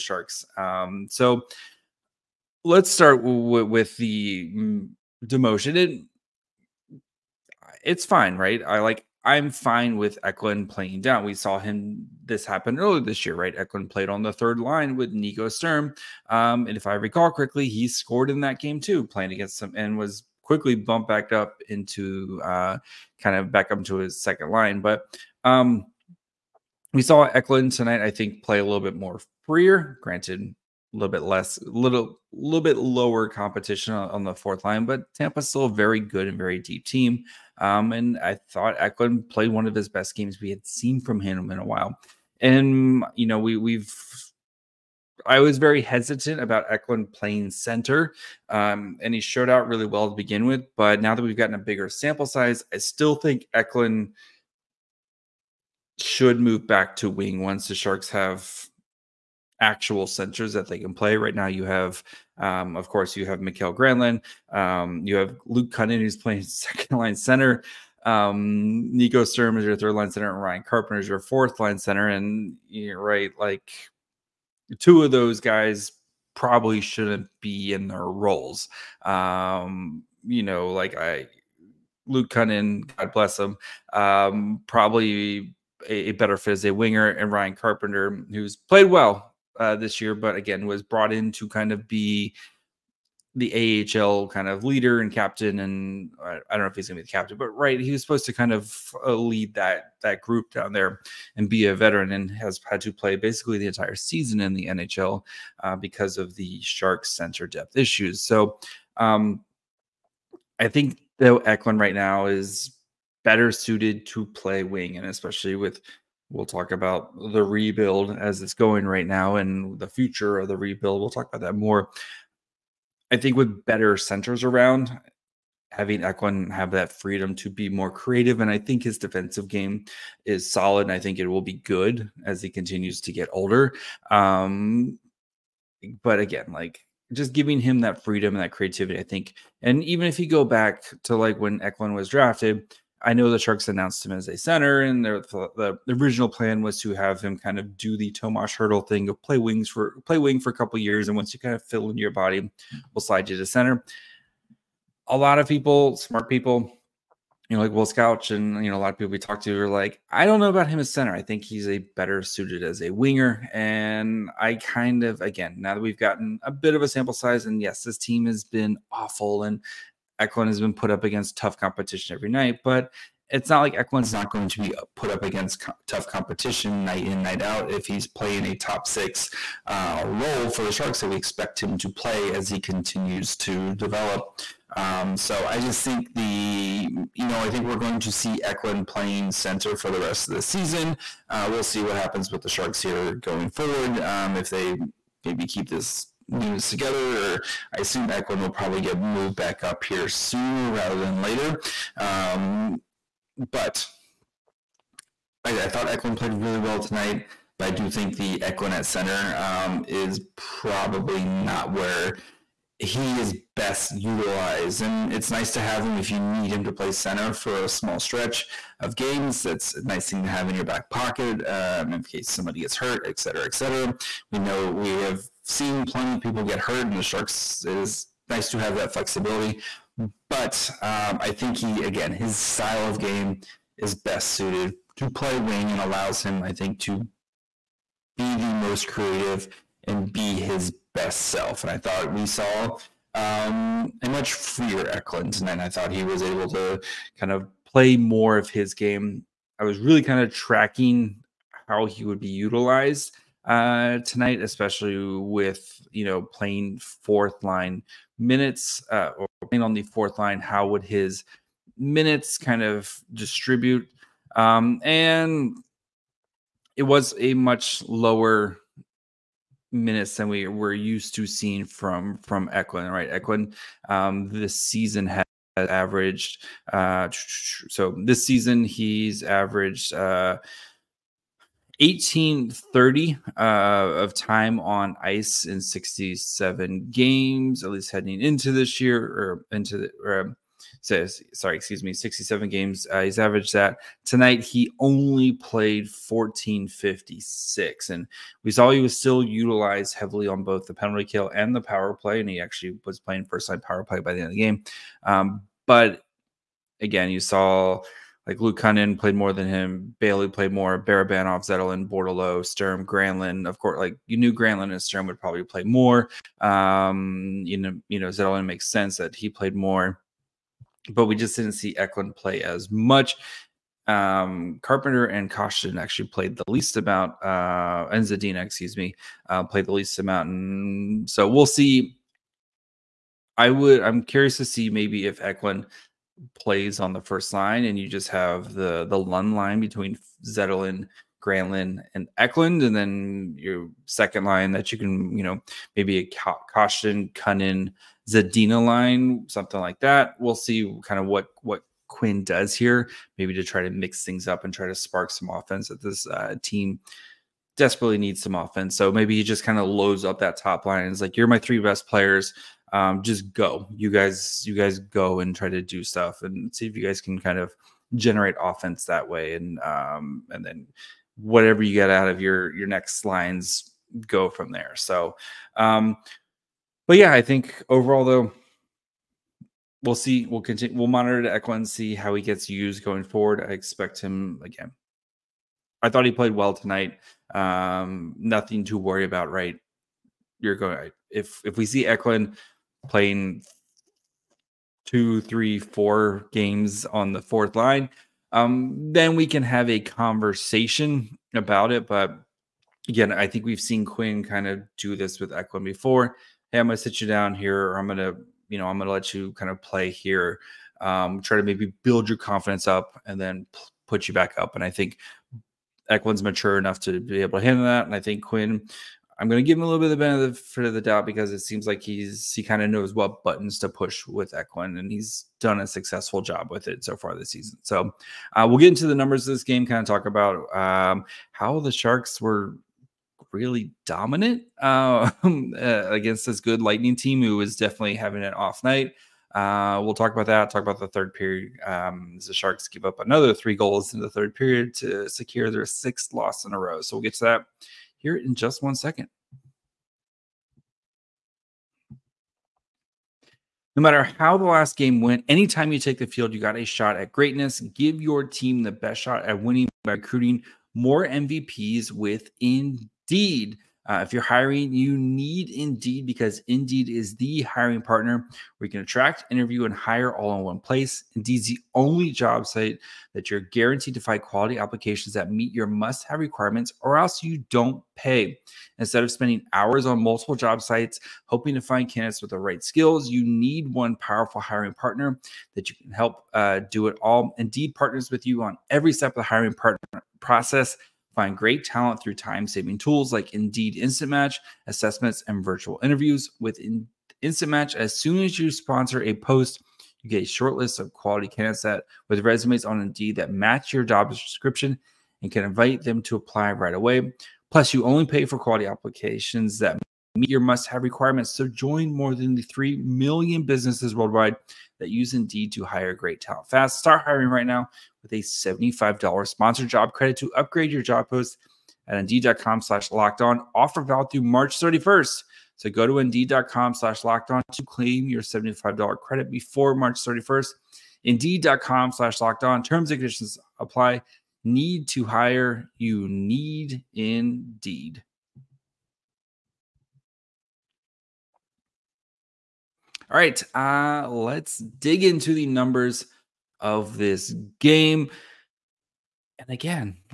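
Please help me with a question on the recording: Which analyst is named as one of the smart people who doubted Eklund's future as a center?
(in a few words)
Will Scouch.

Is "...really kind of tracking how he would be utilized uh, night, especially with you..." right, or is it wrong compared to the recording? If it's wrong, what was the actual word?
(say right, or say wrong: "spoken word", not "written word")
wrong: "tonight", not "night".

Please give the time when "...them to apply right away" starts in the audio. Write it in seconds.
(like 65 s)
505 s.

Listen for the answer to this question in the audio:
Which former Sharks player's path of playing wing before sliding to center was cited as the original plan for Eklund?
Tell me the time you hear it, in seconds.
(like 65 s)
148 s.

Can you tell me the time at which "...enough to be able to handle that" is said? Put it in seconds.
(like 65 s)
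416 s.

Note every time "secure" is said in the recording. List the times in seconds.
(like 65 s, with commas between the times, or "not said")
445 s.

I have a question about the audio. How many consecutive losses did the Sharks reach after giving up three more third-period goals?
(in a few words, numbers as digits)
6.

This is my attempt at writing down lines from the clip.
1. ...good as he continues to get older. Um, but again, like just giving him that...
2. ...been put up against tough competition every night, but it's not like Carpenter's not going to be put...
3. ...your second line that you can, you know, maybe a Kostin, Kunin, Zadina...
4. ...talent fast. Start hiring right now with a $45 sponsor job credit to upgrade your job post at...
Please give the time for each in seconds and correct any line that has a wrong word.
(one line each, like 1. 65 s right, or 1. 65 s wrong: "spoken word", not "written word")
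1. 131 s right
2. 170 s wrong: "Eklund", not "Carpenter"
3. 343 s right
4. 516 s wrong: "75", not "45".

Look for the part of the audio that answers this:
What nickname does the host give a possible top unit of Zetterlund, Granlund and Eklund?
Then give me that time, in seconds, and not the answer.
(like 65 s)
338 s.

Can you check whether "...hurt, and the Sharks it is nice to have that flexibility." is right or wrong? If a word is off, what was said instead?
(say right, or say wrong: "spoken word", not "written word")
right.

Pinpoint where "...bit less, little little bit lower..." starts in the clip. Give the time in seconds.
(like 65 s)
31 s.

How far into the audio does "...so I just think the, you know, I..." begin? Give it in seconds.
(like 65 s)
185 s.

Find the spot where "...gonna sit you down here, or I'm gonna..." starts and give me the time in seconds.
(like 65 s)
406 s.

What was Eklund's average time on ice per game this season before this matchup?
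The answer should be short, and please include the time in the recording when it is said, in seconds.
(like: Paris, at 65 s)
18:30, at 281 s.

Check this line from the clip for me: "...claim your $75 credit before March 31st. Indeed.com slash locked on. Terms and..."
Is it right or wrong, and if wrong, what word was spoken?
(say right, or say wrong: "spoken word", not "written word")
right.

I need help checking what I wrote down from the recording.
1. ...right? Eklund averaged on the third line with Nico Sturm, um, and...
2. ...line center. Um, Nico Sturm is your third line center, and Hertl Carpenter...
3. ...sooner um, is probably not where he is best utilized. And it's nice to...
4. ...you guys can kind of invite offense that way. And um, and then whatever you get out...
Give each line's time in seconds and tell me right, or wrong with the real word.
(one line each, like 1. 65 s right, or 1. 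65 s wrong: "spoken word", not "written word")
1. 13 s wrong: "played", not "averaged"
2. 66 s wrong: "Ryan", not "Hertl"
3. 208 s wrong: "center", not "sooner"
4. 366 s wrong: "generate", not "invite".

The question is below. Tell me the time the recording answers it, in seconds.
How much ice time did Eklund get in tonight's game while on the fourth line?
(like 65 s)
295 s.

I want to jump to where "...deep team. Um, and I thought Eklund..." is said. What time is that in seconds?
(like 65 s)
36 s.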